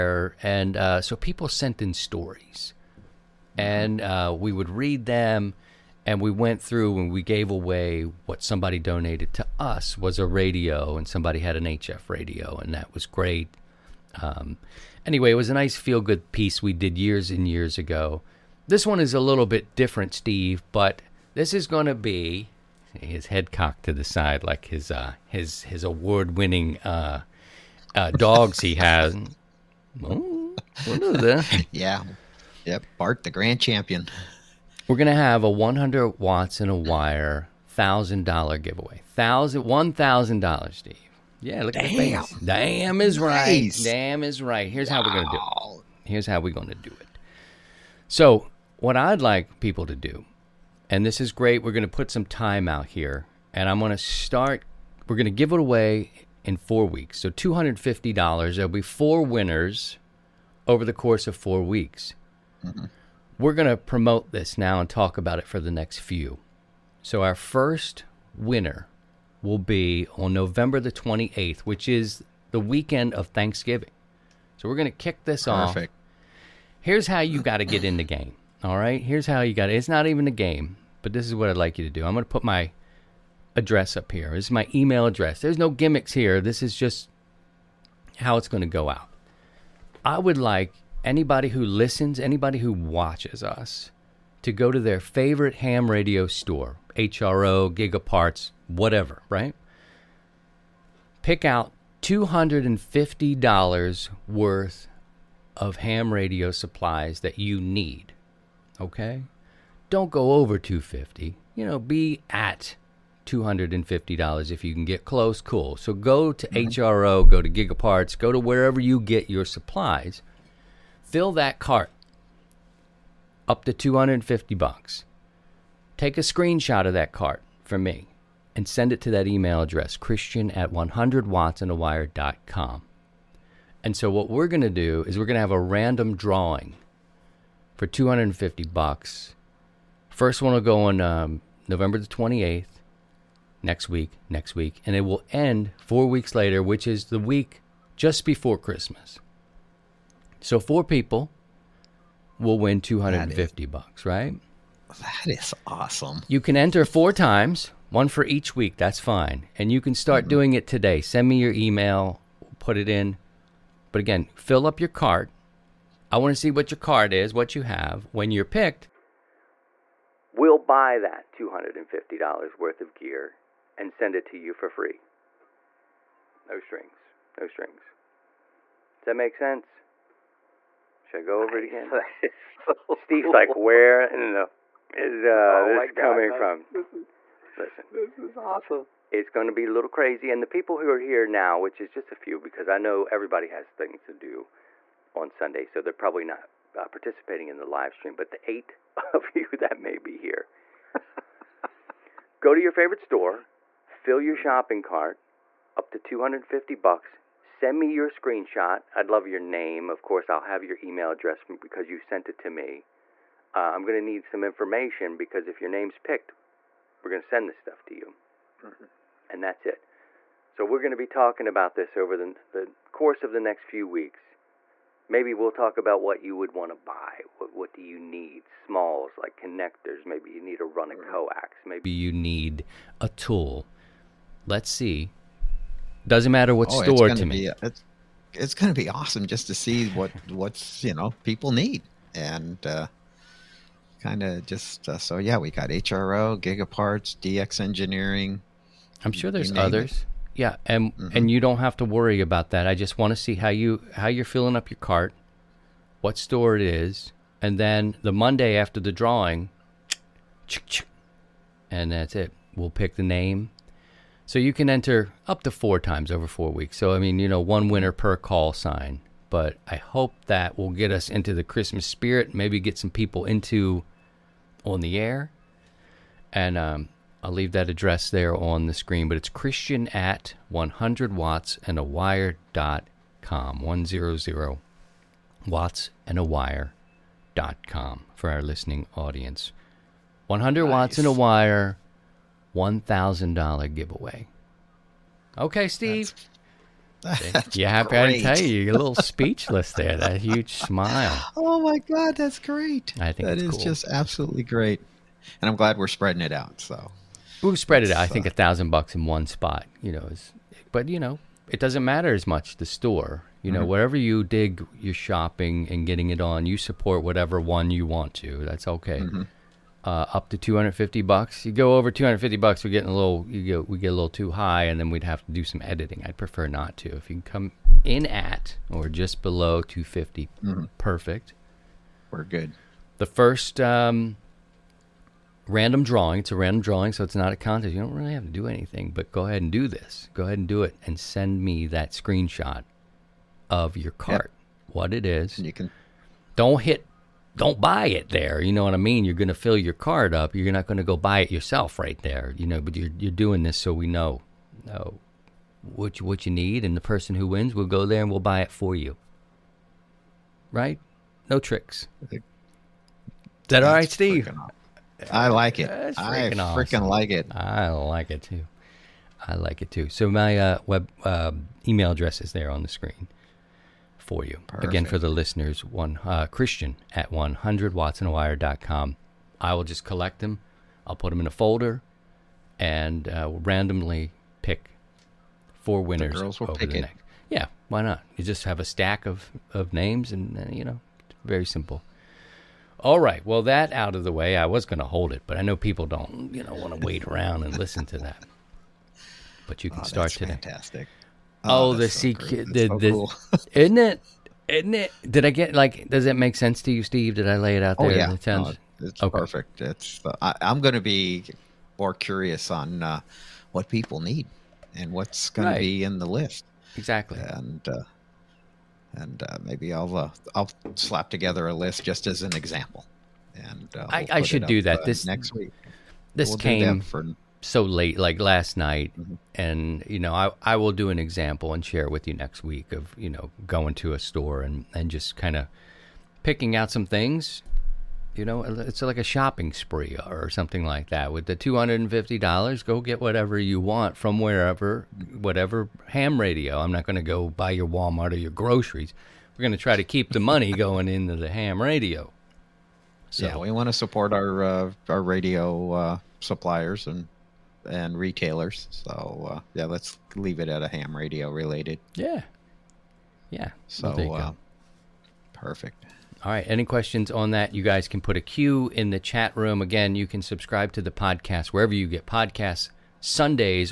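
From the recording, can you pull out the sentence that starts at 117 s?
go to Gigaparts, go to wherever you get your supplies Fill that cart up to 250 bucks.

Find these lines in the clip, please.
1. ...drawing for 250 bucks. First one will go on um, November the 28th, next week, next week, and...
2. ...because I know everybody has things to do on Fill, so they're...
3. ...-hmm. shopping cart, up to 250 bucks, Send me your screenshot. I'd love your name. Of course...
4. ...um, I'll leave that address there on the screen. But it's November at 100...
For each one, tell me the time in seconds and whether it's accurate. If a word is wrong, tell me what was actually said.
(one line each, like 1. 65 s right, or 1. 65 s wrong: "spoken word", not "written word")
1. 136 s right
2. 192 s wrong: "Sunday", not "Fill"
3. 204 s right
4. 276 s wrong: "Christian", not "November".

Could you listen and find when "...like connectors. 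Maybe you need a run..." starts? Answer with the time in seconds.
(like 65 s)
229 s.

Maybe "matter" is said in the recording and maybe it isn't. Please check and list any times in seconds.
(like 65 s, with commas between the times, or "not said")
236 s, 311 s.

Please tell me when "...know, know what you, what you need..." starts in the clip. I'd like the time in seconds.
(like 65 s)
353 s.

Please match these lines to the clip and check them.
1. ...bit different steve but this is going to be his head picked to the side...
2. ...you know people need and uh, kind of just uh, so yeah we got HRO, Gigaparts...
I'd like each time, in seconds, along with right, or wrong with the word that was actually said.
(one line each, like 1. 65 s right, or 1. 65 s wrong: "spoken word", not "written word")
1. 19 s wrong: "cocked", not "picked"
2. 240 s right.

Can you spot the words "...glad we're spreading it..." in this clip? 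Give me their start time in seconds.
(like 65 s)
305 s.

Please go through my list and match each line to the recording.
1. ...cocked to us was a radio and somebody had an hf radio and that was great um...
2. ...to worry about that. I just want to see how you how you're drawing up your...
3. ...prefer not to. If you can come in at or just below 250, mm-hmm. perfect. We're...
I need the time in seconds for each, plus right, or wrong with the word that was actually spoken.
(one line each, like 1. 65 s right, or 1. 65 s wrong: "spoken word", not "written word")
1. 8 s wrong: "donated", not "cocked"
2. 251 s wrong: "filling", not "drawing"
3. 326 s right.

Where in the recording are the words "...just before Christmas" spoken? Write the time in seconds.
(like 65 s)
147 s.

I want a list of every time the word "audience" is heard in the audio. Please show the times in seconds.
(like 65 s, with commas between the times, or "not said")
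288 s.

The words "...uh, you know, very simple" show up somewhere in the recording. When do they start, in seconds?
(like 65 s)
390 s.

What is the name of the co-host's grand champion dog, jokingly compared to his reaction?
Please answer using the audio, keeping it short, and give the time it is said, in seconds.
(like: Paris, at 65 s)
Bart, at 32 s.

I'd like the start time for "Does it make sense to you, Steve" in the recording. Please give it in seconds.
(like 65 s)
405 s.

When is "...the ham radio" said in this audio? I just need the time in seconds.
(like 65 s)
451 s.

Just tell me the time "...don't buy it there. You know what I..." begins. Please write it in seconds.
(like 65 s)
347 s.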